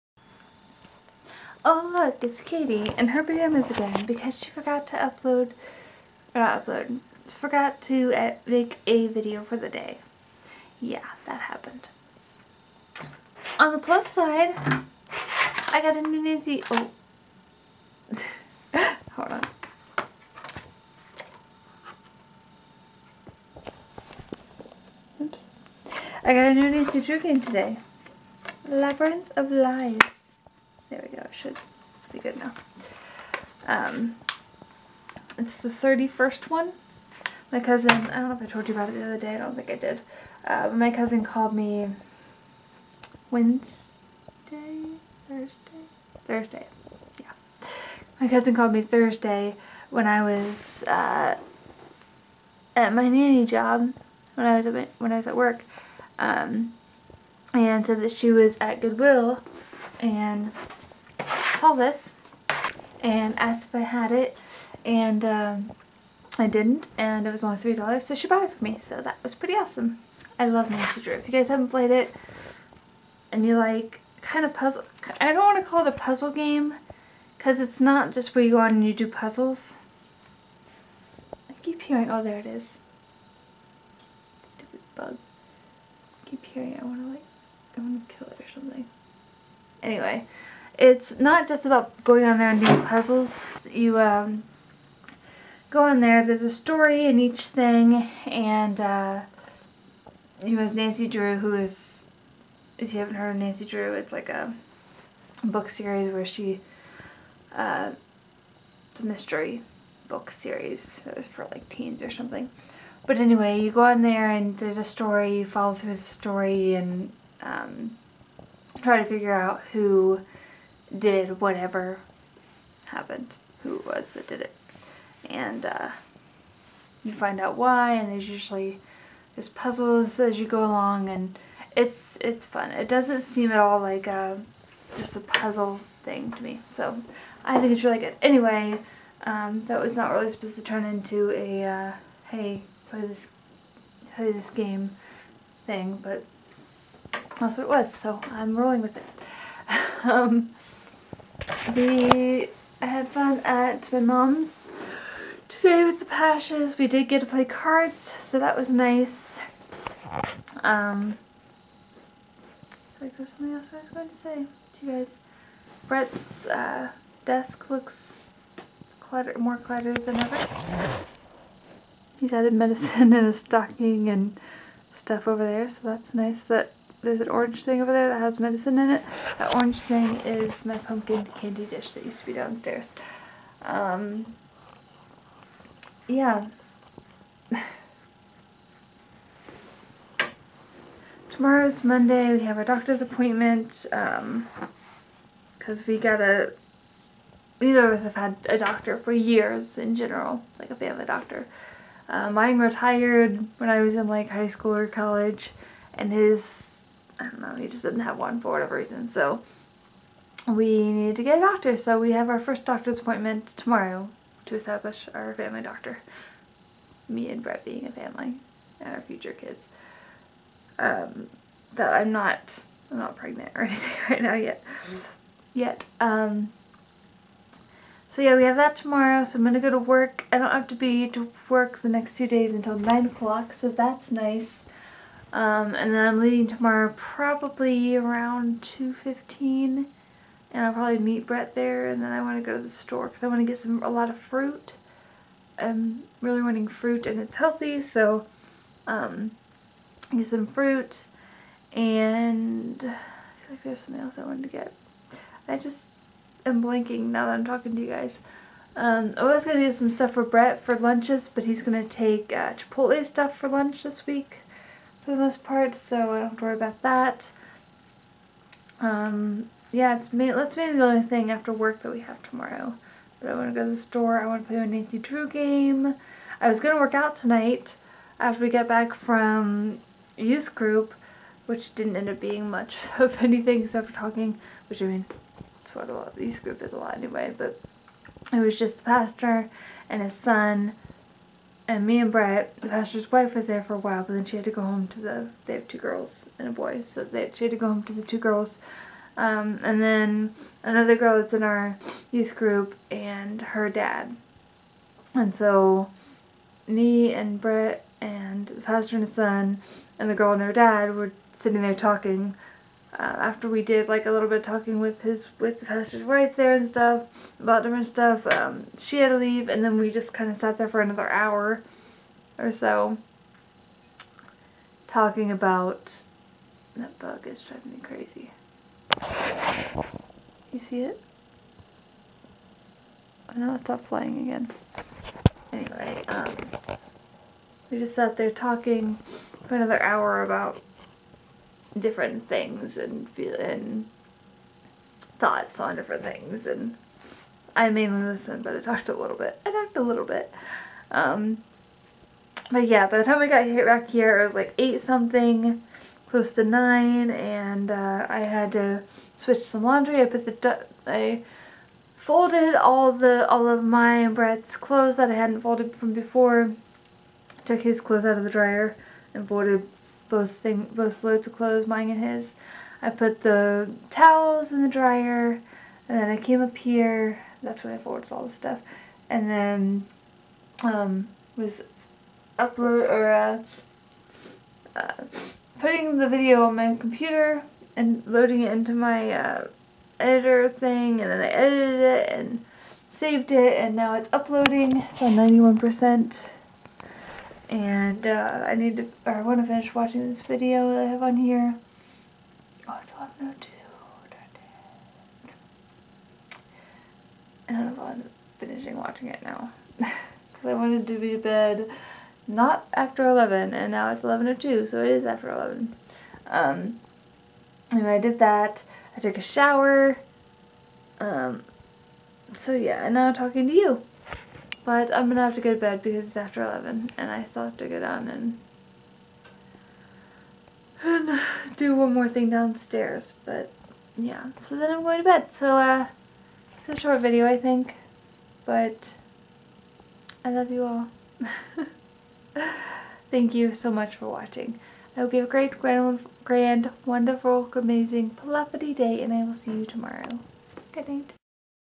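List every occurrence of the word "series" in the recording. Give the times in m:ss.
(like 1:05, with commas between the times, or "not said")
1:45, 1:50.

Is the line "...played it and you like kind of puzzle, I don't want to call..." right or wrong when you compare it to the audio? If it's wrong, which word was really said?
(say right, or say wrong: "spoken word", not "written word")
right.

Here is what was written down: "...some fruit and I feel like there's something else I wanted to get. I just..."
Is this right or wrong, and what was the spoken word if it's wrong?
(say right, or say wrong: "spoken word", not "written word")
right.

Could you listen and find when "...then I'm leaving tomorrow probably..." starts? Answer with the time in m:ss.
3:55.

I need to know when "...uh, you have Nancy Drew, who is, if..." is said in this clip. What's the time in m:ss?
1:38.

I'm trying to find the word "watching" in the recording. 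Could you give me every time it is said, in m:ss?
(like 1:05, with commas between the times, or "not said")
6:39, 6:48, 7:24.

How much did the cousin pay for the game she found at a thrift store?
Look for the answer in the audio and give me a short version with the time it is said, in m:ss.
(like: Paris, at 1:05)
3 dollars, at 1:07.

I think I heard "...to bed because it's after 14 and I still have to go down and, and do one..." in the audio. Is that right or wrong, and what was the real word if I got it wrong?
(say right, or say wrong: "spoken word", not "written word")
wrong: "11", not "14".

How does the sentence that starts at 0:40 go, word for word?
Uh, but my cousin called me Wednesday, Thursday, Thursday, yeah.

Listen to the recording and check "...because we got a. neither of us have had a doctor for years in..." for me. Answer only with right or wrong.
right.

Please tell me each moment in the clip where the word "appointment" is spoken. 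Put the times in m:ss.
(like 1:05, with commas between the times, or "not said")
3:13, 3:32.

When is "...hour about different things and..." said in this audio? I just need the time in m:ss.
5:39.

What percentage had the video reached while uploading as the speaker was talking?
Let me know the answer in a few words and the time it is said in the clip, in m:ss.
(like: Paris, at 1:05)
91%, at 6:35.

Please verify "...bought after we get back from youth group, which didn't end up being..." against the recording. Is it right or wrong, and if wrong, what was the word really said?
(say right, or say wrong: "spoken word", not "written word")
wrong: "tonight", not "bought".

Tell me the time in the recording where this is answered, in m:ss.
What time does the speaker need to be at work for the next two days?
3:52.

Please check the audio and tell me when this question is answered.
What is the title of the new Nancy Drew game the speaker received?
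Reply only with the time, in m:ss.
0:28.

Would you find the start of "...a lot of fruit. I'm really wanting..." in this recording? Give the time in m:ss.
4:03.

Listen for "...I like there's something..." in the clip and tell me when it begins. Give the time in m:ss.
2:42.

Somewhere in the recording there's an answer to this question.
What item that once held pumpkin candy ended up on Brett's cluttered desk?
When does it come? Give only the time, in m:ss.
3:00.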